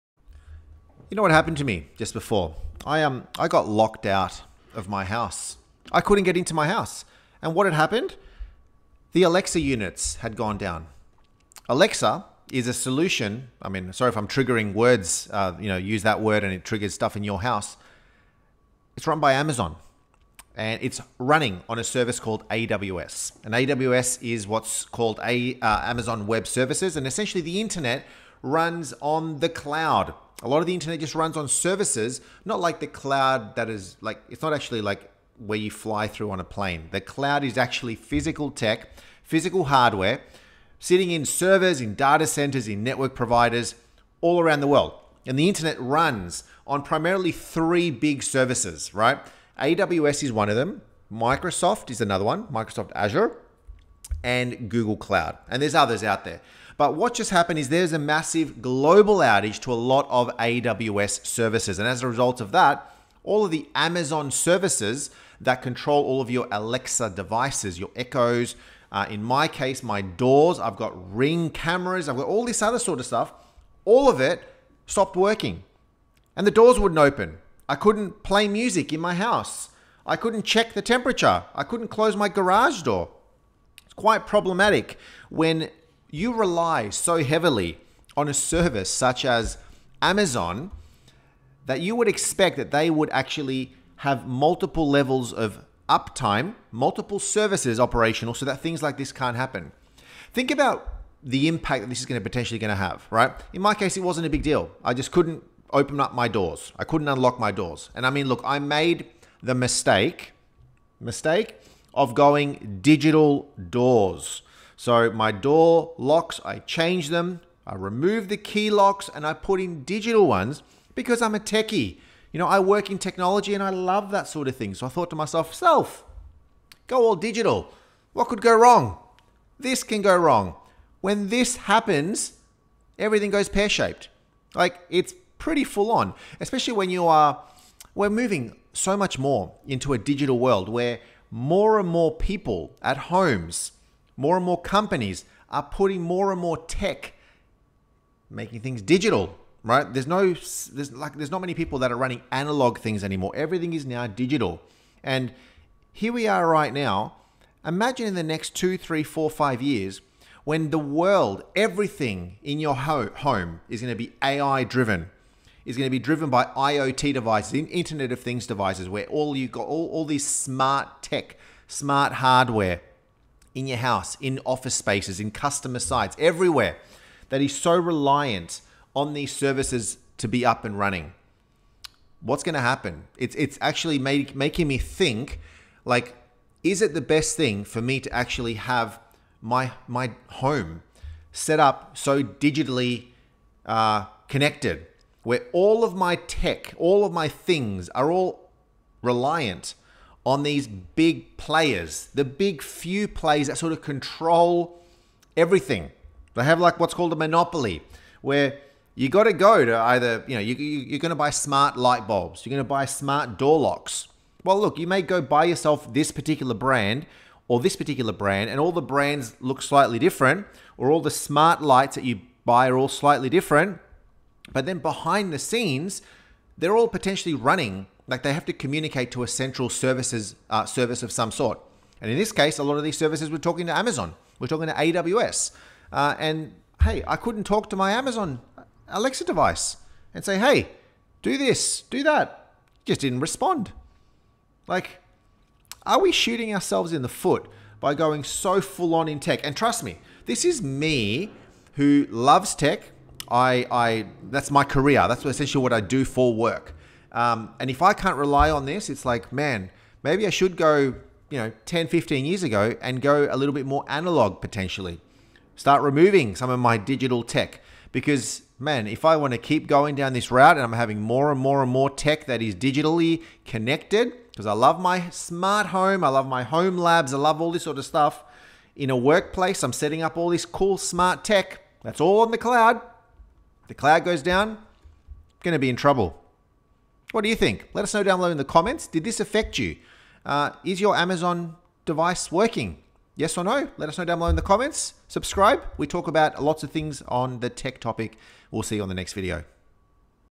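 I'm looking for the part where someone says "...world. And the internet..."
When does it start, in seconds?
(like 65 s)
44 s.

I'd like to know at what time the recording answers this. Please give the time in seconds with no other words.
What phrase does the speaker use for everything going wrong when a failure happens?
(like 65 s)
133 s.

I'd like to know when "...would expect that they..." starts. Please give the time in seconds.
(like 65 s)
91 s.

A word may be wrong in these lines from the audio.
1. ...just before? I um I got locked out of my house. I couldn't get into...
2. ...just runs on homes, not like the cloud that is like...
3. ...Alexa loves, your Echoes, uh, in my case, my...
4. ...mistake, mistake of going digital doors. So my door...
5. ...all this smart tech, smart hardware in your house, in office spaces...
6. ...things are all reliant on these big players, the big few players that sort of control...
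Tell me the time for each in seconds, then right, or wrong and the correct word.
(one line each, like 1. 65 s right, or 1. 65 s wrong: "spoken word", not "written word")
1. 1 s right
2. 30 s wrong: "services", not "homes"
3. 66 s wrong: "devices", not "loves"
4. 109 s right
5. 169 s right
6. 197 s right.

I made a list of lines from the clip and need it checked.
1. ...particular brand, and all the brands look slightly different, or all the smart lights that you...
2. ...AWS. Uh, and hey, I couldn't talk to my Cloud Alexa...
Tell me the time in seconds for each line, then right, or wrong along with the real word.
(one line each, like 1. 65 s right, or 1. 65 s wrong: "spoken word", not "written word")
1. 217 s right
2. 234 s wrong: "Amazon", not "Cloud".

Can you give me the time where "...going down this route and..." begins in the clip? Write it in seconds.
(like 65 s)
269 s.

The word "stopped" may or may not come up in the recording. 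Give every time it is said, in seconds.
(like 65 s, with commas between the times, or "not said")
74 s.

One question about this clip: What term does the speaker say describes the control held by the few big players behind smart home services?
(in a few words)
monopoly.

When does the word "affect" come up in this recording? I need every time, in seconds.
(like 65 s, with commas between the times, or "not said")
289 s.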